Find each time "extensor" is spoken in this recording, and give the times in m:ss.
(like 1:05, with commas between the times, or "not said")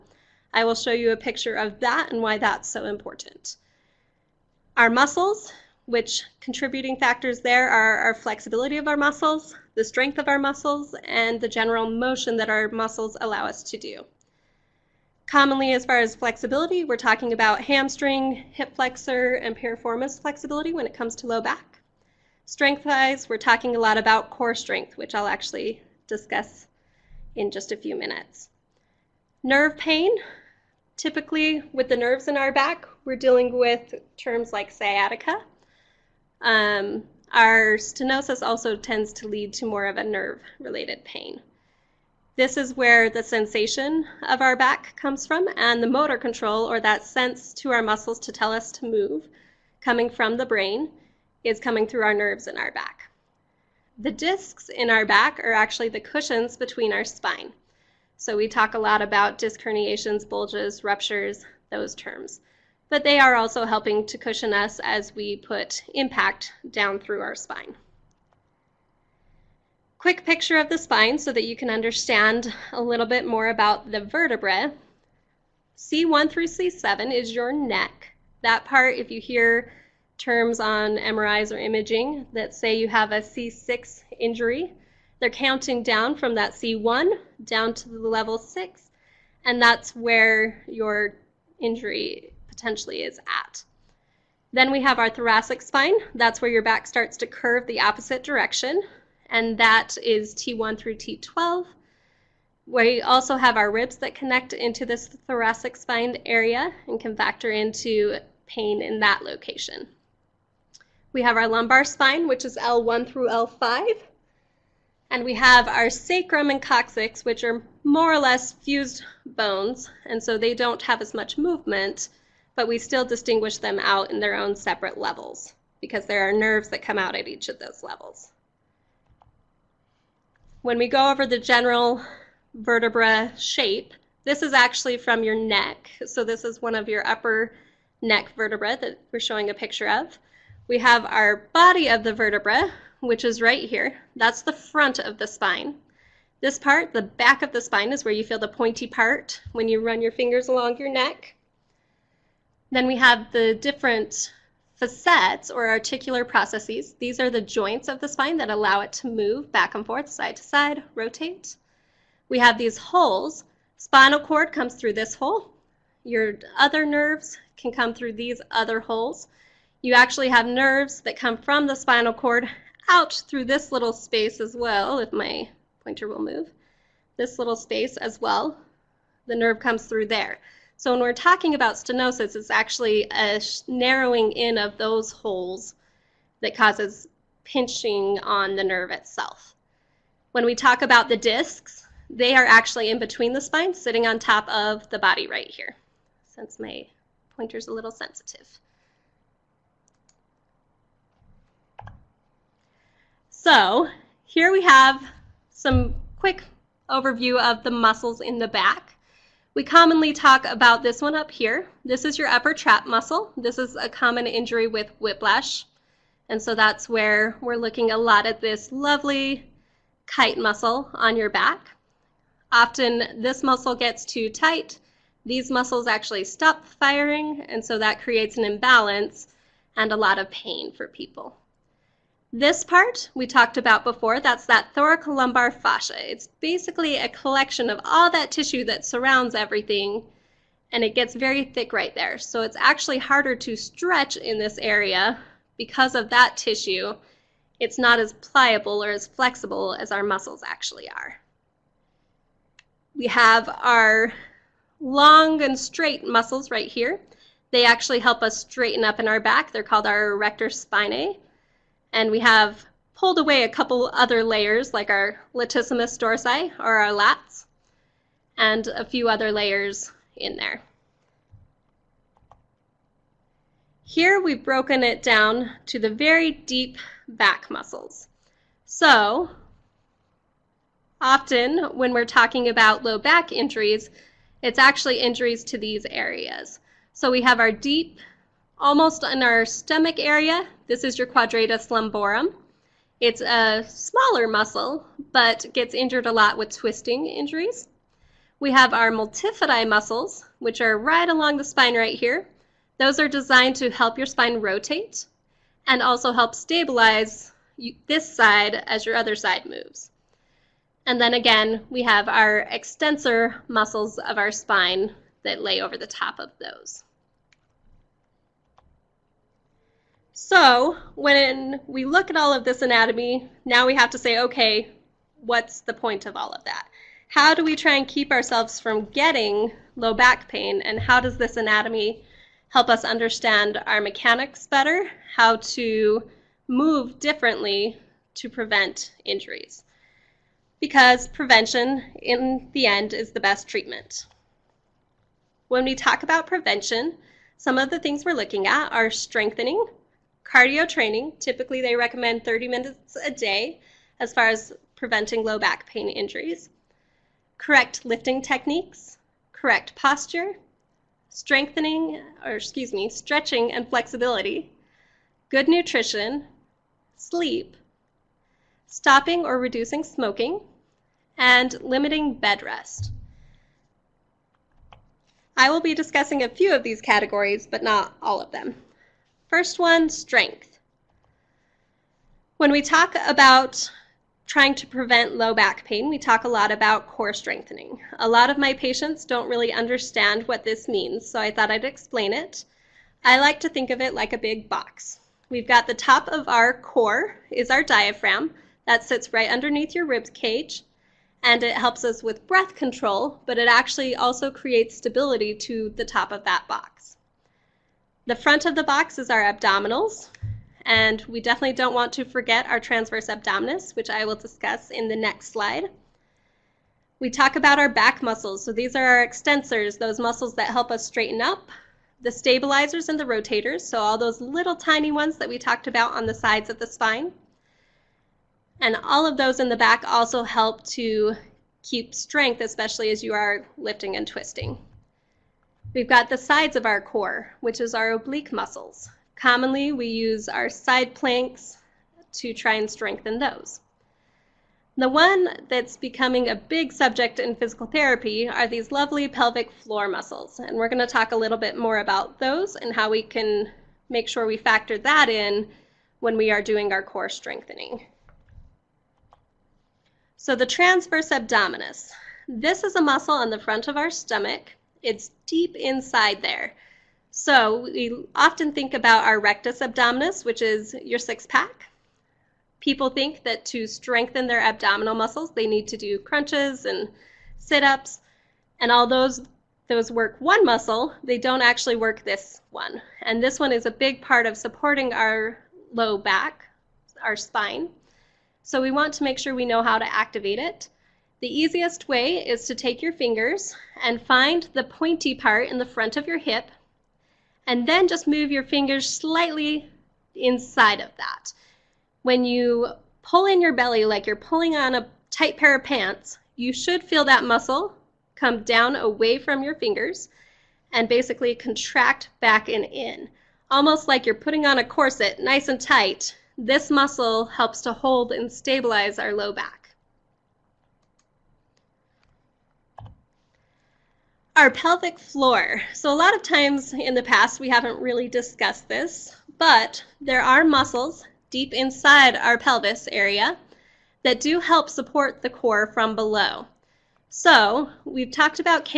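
5:12, 6:59.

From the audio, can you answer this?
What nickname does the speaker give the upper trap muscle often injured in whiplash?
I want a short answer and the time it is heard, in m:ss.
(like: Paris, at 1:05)
kite muscle, at 3:40.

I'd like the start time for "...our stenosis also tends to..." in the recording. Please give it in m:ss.
0:37.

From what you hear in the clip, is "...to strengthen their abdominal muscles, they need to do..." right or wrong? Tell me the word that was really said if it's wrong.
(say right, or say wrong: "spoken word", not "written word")
right.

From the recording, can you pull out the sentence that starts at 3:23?
So here we have some quick overview of the muscles in the back.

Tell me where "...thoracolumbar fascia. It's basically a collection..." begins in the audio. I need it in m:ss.
3:54.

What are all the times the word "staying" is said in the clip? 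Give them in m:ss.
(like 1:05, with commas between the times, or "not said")
not said.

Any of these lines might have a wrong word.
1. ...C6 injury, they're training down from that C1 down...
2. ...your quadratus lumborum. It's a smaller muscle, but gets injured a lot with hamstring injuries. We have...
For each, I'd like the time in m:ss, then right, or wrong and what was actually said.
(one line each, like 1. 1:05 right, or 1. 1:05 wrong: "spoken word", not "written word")
1. 1:23 wrong: "counting", not "training"
2. 4:50 wrong: "twisting", not "hamstring".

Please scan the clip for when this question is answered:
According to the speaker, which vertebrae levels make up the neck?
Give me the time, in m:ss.
1:15.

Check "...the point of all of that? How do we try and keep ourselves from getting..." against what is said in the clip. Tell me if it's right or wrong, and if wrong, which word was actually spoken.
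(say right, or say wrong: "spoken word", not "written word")
right.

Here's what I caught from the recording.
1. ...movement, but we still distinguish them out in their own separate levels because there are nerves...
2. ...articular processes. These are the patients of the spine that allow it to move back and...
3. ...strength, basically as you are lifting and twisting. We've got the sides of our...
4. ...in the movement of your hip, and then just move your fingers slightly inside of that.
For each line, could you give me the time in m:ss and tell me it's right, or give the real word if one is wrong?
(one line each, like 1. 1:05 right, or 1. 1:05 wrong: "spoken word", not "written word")
1. 2:01 right
2. 2:35 wrong: "joints", not "patients"
3. 7:11 wrong: "especially", not "basically"
4. 8:15 wrong: "front", not "movement".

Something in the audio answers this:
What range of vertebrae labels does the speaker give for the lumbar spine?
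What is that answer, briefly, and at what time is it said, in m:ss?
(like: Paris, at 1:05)
L1 through L5, at 1:52.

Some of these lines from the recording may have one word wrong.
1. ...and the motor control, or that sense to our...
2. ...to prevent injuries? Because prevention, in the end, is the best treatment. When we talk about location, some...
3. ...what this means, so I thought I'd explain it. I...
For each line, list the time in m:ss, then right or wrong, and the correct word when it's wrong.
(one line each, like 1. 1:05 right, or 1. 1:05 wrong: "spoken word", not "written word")
1. 0:45 right
2. 5:38 wrong: "prevention", not "location"
3. 6:30 right.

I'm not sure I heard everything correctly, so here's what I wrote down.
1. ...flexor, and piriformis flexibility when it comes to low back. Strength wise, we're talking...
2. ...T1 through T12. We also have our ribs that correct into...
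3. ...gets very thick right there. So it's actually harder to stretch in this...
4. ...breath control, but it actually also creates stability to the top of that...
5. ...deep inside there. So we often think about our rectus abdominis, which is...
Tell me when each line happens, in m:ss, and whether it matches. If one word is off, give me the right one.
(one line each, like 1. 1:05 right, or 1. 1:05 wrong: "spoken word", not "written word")
1. 0:18 right
2. 1:40 wrong: "connect", not "correct"
3. 4:00 right
4. 6:42 right
5. 7:45 right.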